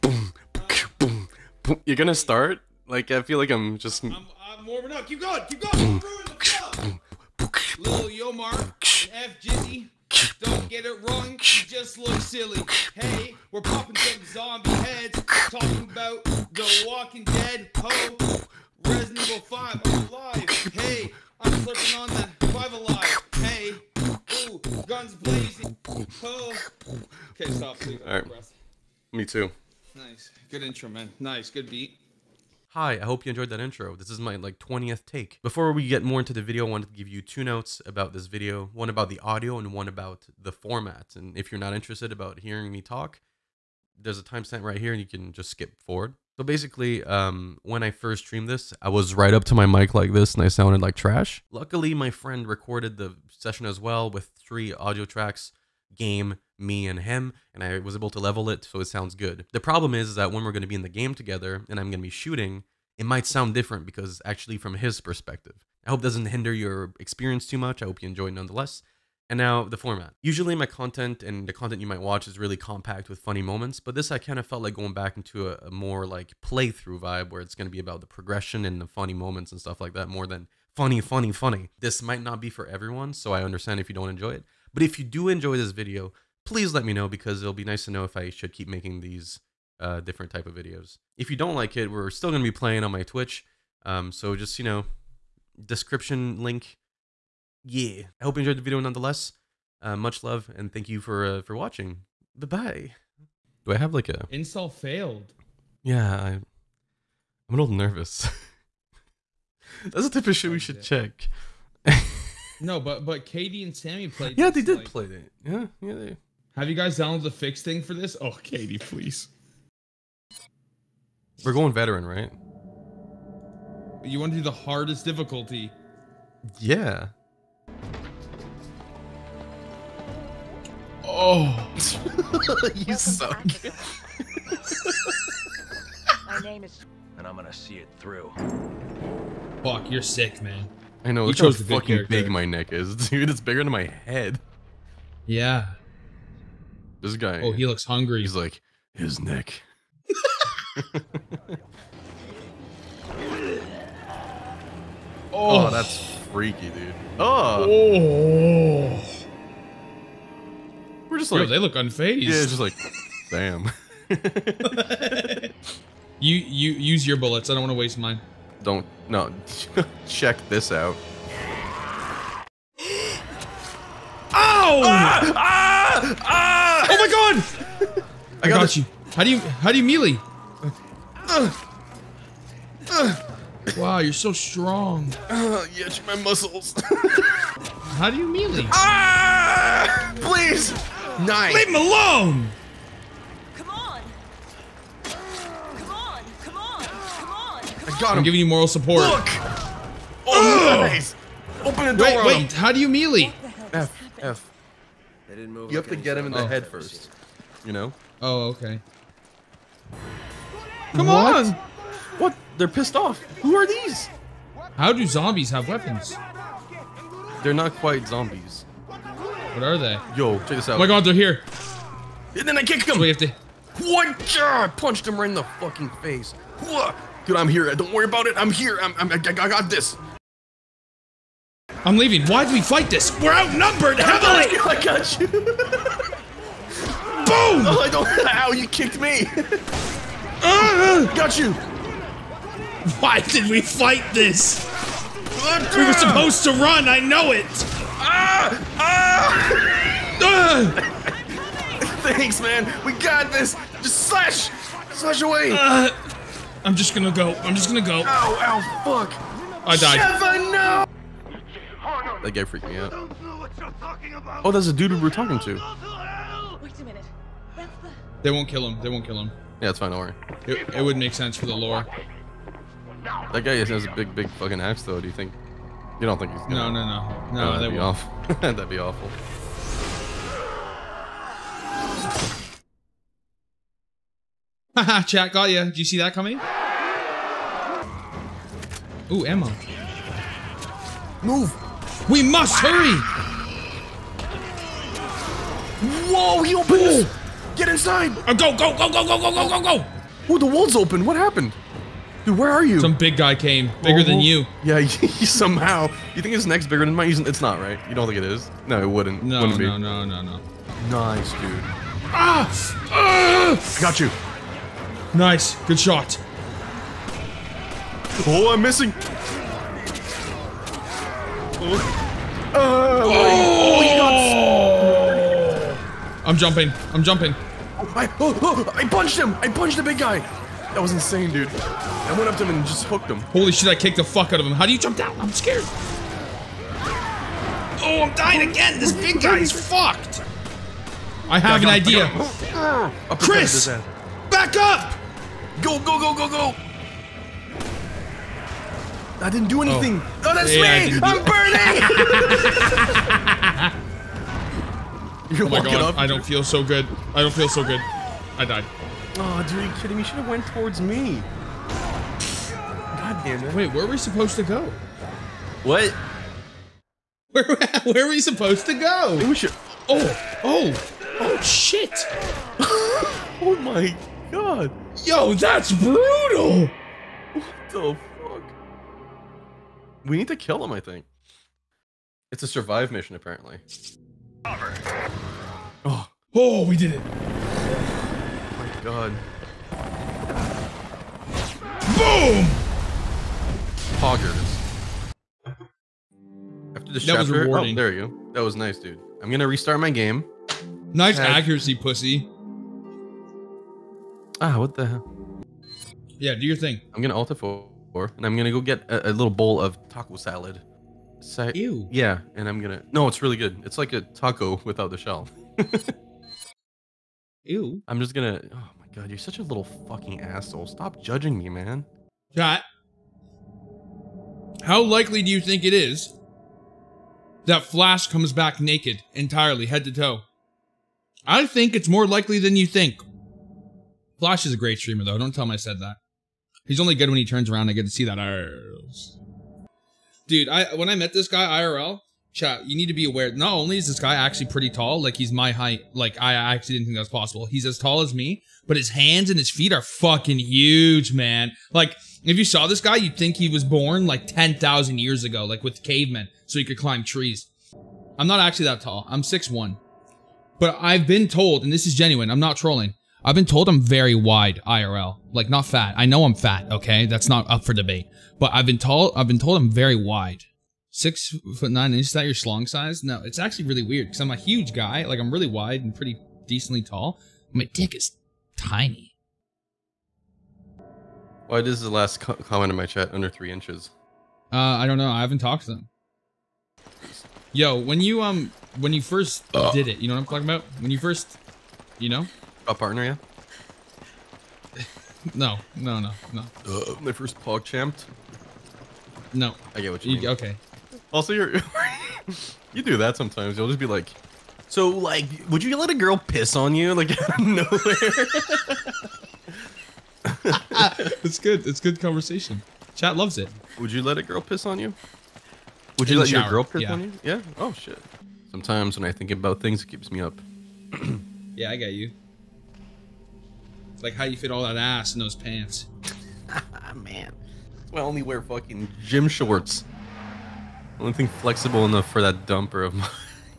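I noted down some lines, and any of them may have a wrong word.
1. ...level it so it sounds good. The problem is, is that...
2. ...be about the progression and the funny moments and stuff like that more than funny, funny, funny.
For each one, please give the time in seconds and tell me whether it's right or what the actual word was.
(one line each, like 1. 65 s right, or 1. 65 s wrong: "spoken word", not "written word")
1. 58 s right
2. 77 s right.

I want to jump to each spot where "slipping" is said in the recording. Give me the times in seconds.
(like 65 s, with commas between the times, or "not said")
21 s.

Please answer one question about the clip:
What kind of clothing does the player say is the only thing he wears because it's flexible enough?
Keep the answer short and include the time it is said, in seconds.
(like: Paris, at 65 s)
gym shorts, at 529 s.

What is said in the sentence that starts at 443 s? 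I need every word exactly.
Not only is this guy actually pretty tall, like he's my height.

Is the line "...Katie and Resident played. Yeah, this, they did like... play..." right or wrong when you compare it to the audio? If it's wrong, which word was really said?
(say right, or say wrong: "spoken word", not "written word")
wrong: "Sammy", not "Resident".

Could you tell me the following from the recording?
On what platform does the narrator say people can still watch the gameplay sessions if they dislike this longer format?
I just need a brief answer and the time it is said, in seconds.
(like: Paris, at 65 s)
Twitch, at 93 s.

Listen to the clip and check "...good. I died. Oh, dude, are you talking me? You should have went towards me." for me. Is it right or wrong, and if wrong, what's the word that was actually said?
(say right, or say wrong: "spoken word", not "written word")
wrong: "kidding", not "talking".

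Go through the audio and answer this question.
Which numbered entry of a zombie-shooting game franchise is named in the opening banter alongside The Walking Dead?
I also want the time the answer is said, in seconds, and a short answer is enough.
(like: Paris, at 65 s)
Resident Evil 5, at 18 s.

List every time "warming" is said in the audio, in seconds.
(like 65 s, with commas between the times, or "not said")
4 s.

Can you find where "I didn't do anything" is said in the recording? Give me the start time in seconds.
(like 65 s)
349 s.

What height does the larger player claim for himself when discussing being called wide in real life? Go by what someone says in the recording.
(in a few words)
6'1".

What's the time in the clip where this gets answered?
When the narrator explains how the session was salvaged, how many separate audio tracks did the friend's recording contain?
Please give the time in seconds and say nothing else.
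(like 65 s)
54 s.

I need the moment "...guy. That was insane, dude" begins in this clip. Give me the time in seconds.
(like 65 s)
329 s.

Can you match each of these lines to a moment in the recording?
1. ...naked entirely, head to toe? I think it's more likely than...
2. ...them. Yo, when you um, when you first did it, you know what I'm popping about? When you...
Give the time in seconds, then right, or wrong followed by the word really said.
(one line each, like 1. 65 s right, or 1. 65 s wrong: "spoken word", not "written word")
1. 428 s right
2. 485 s wrong: "talking", not "popping".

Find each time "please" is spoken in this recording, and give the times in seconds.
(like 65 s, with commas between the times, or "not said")
86 s, 118 s, 190 s.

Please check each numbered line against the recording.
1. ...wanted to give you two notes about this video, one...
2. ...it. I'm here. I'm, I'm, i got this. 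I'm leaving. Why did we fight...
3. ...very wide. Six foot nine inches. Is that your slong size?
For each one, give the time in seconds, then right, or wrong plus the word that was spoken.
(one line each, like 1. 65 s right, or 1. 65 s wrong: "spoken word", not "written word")
1. 36 s right
2. 228 s right
3. 469 s right.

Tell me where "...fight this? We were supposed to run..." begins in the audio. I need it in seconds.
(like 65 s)
243 s.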